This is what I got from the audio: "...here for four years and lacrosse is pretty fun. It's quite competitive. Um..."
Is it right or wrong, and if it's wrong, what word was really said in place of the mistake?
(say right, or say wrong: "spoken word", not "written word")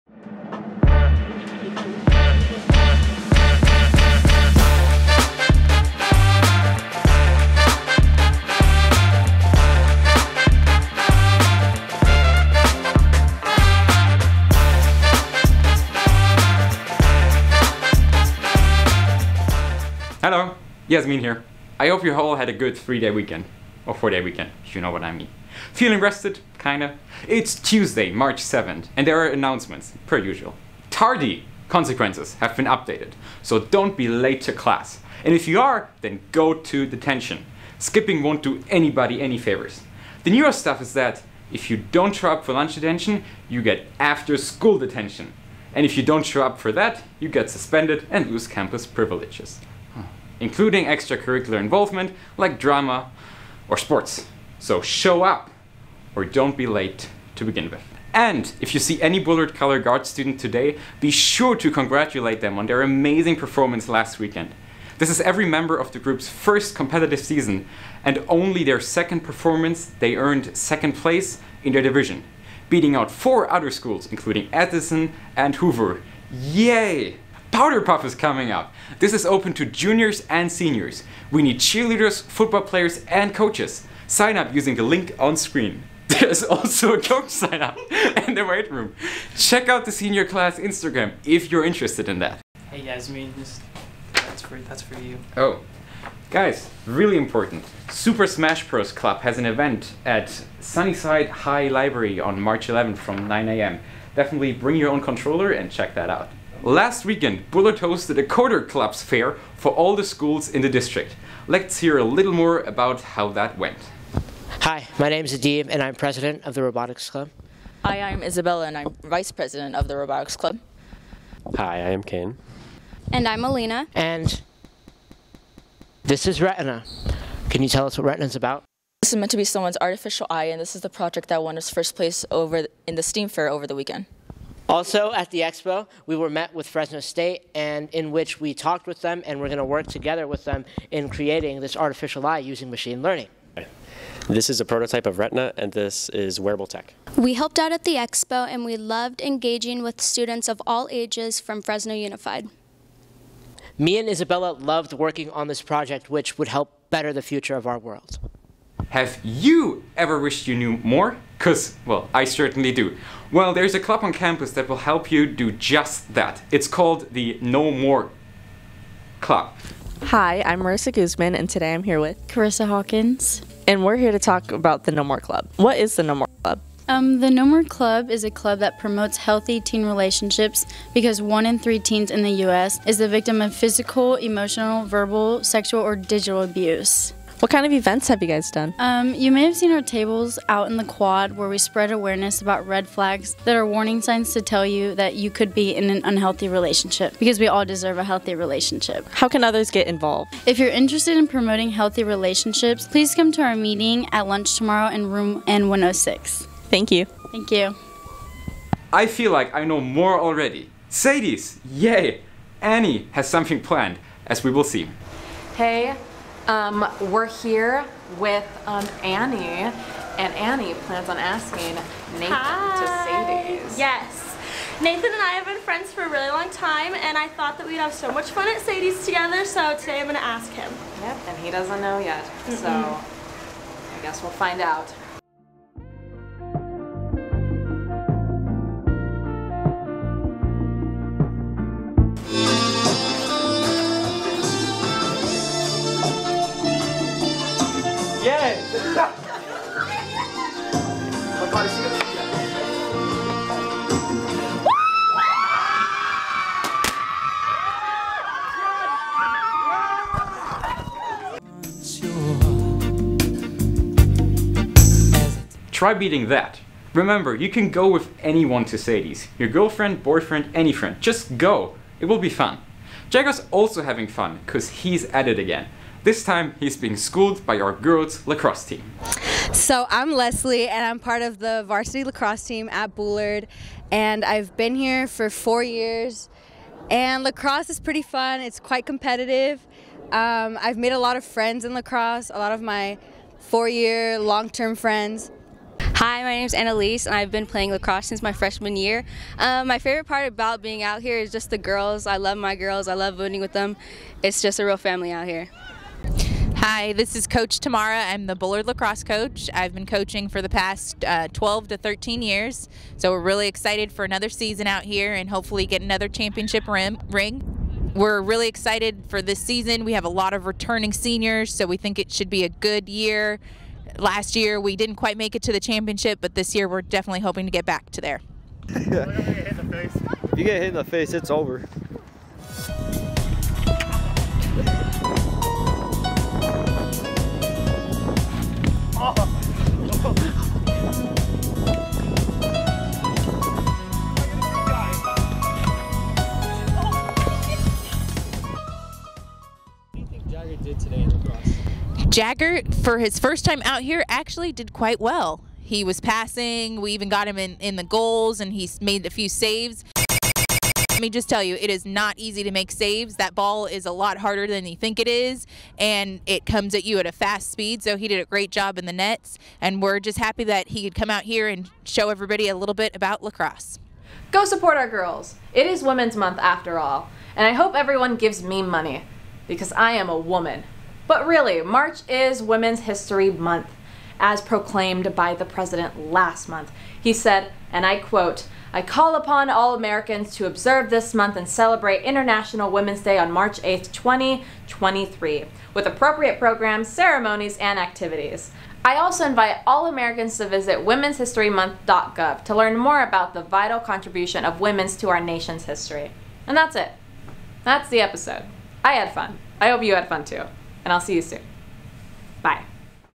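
right.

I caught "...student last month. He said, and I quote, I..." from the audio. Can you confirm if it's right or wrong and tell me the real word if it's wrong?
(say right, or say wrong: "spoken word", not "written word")
wrong: "president", not "student".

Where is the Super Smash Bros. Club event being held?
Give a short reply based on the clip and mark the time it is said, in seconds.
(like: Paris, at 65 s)
Sunnyside High Library, at 100 s.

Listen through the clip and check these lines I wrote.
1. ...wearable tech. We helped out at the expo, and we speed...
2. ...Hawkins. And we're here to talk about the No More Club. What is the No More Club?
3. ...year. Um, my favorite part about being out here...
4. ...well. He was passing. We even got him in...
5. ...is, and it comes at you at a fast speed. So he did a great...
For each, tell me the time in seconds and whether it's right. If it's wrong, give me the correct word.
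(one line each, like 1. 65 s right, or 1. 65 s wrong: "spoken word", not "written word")
1. 146 s wrong: "loved", not "speed"
2. 172 s right
3. 298 s right
4. 354 s right
5. 365 s right.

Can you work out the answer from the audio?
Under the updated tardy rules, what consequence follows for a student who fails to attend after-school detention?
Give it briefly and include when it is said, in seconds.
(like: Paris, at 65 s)
Suspended, at 47 s.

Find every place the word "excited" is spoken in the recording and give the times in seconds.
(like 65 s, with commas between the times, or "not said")
313 s, 318 s.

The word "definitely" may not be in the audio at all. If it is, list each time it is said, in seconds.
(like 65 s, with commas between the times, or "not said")
104 s, 326 s.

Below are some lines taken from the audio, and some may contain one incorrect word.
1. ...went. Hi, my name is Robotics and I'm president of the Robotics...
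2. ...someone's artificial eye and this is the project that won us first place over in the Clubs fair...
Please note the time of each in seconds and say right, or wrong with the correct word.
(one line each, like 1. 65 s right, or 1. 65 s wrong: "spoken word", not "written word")
1. 113 s wrong: "Adib", not "Robotics"
2. 129 s wrong: "STEAM", not "Clubs".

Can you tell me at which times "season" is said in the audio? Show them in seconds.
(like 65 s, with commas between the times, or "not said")
67 s, 314 s, 319 s.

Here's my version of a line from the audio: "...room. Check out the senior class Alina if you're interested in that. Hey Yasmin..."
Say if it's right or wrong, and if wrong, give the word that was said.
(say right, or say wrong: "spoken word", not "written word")
wrong: "Instagram", not "Alina".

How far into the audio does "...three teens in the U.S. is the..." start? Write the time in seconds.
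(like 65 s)
181 s.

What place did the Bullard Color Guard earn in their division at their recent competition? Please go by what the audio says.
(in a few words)
Second place.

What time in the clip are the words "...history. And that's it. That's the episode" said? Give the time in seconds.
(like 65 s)
405 s.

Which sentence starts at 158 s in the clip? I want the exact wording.
Have you ever wished you knew more?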